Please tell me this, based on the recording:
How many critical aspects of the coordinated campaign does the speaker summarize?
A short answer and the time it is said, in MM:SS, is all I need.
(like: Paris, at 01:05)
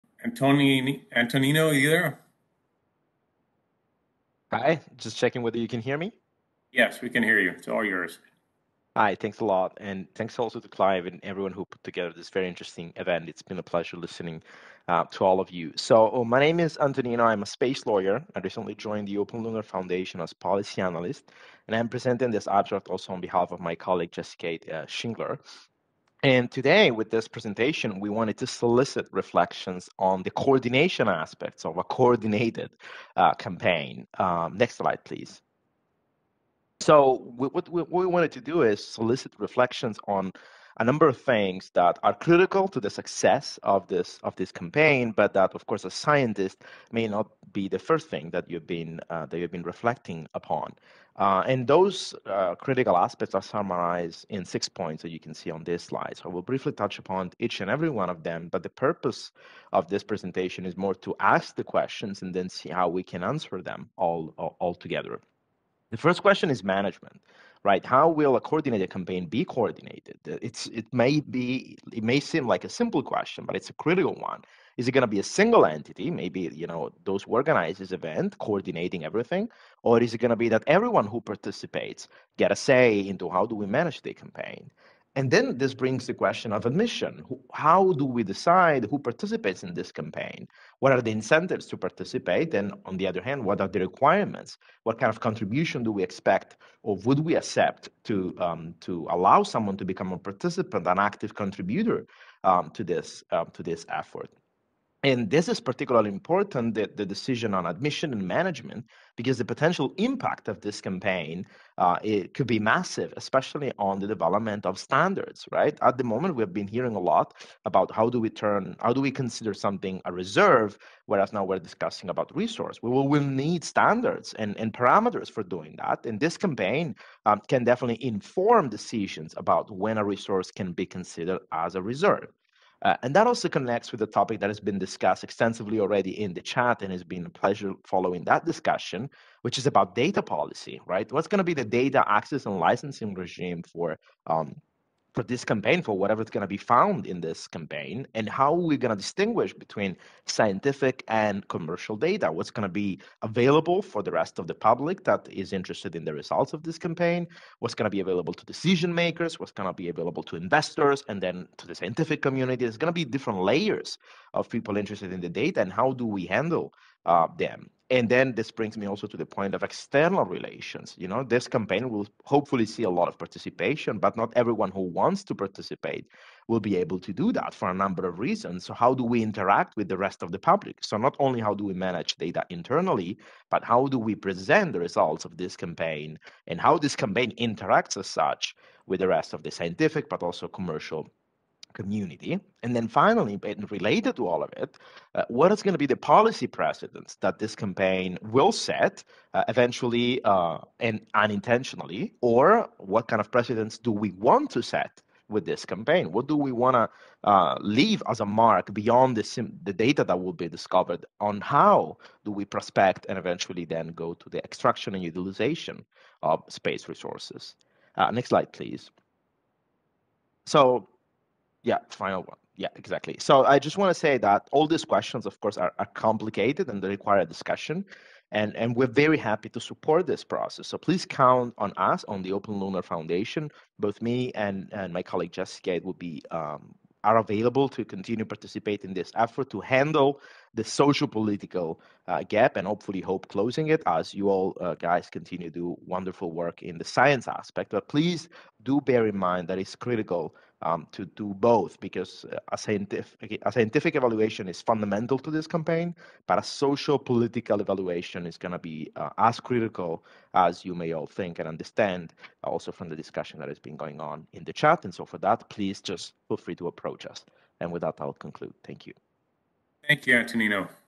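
6, at 00:54.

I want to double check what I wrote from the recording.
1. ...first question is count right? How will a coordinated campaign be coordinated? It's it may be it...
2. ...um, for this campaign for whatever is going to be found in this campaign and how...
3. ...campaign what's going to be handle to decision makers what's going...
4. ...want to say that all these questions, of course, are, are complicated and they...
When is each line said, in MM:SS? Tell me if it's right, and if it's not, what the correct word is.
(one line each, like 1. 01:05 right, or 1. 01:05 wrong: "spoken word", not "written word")
1. 01:05 wrong: "management", not "count"
2. 02:24 right
3. 02:36 wrong: "available", not "handle"
4. 03:43 right.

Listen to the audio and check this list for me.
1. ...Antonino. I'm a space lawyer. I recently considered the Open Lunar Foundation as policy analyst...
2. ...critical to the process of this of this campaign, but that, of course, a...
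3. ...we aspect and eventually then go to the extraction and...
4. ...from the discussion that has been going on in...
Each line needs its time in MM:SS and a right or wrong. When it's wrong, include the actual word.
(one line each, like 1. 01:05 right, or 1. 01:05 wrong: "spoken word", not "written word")
1. 00:16 wrong: "joined", not "considered"
2. 00:42 wrong: "success", not "process"
3. 03:32 wrong: "prospect", not "aspect"
4. 04:22 right.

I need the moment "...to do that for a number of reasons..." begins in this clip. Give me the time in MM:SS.
02:56.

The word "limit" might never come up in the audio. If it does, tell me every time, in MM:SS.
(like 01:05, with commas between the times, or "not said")
not said.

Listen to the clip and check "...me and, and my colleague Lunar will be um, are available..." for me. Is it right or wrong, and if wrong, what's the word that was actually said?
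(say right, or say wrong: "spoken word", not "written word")
wrong: "Jessica", not "Lunar".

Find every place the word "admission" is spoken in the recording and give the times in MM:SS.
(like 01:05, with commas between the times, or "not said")
01:26, 01:47.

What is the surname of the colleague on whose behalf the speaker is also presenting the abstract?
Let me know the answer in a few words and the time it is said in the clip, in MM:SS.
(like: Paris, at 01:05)
Schingler, at 00:24.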